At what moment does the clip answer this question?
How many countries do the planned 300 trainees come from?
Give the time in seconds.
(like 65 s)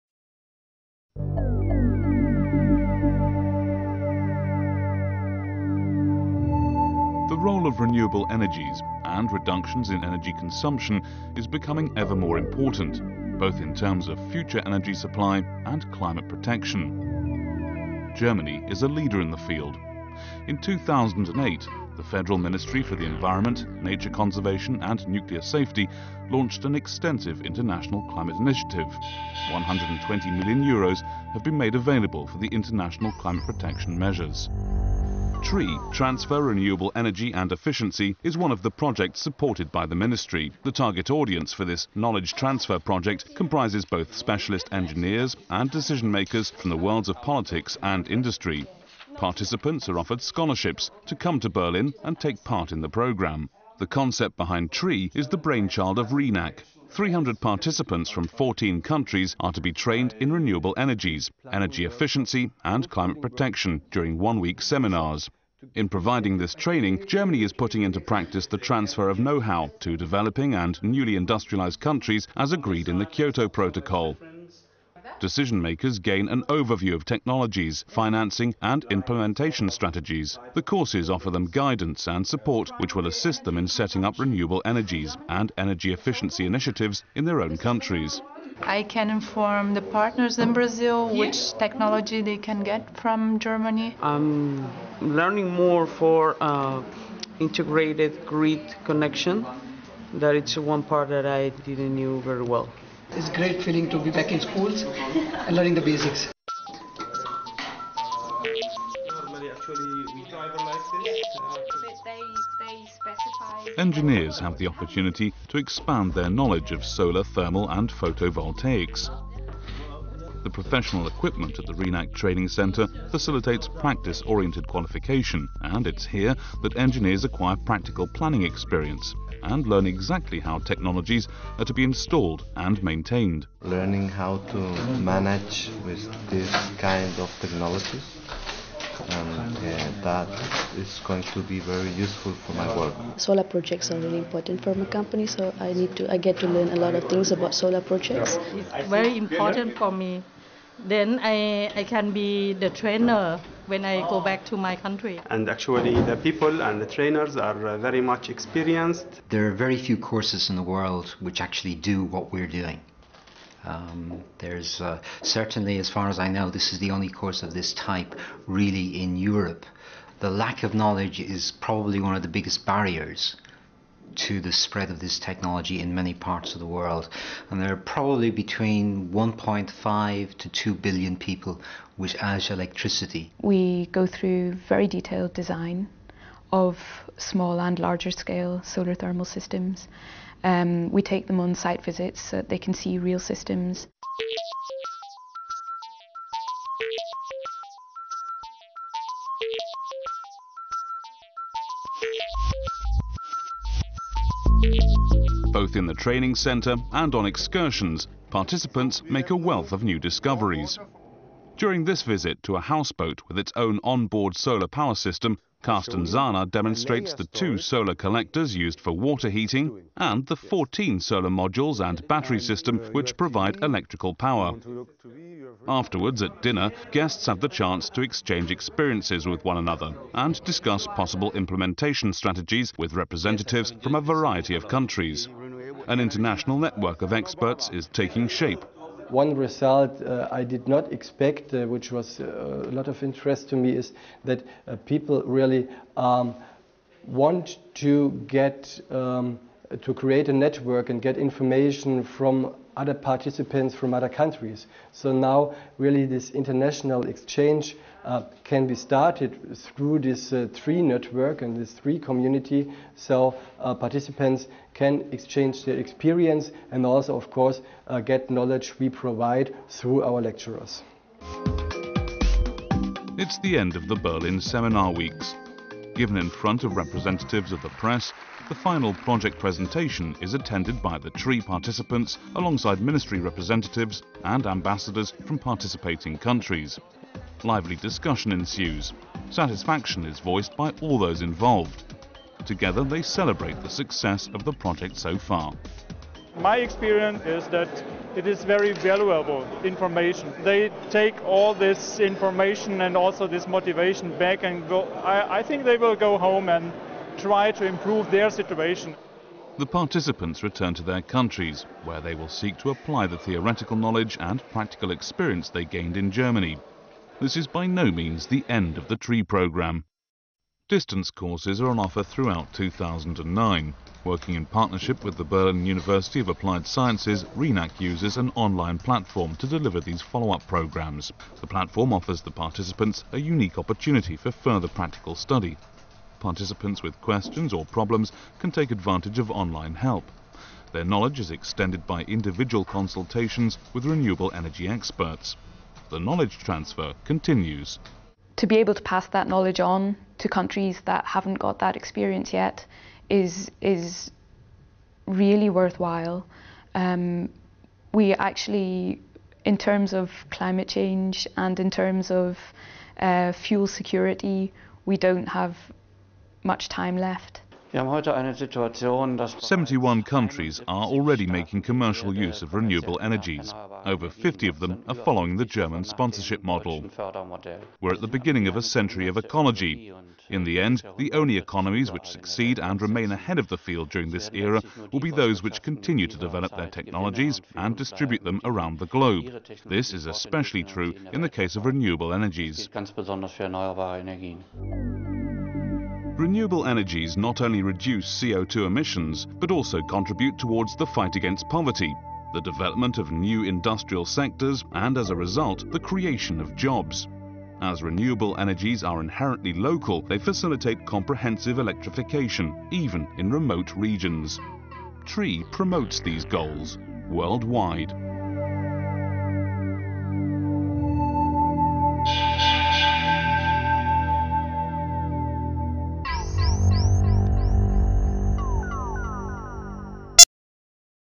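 58 s.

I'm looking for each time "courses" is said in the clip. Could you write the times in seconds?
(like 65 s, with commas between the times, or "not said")
80 s, 160 s, 167 s, 267 s, 321 s.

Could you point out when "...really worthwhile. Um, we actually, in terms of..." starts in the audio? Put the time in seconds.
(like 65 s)
355 s.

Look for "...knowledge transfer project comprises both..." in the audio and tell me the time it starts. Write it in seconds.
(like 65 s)
41 s.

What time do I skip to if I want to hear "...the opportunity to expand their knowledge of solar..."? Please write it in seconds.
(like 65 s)
114 s.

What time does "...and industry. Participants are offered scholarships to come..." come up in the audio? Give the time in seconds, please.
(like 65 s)
47 s.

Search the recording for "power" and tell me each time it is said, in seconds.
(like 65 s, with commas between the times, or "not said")
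214 s, 224 s.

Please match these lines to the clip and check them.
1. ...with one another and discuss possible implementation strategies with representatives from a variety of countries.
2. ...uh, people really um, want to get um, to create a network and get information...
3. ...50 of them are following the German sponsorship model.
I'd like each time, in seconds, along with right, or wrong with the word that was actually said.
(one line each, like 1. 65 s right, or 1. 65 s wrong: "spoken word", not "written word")
1. 229 s right
2. 244 s right
3. 374 s right.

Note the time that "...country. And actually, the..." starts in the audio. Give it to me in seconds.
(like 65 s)
154 s.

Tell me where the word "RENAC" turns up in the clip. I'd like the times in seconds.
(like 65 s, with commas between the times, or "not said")
56 s, 121 s, 327 s.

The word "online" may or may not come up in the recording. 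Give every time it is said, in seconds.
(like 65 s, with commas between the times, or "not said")
328 s, 339 s.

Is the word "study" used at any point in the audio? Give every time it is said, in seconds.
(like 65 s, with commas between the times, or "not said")
335 s.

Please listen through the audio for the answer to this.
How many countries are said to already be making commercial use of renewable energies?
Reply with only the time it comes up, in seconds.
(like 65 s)
367 s.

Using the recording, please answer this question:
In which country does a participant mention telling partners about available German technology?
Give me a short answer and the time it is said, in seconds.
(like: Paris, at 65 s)
Brazil, at 90 s.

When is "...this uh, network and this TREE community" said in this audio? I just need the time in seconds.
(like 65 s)
259 s.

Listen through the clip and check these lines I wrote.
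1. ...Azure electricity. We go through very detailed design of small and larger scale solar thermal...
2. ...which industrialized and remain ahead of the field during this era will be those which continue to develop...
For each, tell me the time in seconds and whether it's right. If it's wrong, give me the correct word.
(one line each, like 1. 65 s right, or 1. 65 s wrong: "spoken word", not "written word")
1. 182 s right
2. 381 s wrong: "succeed", not "industrialized".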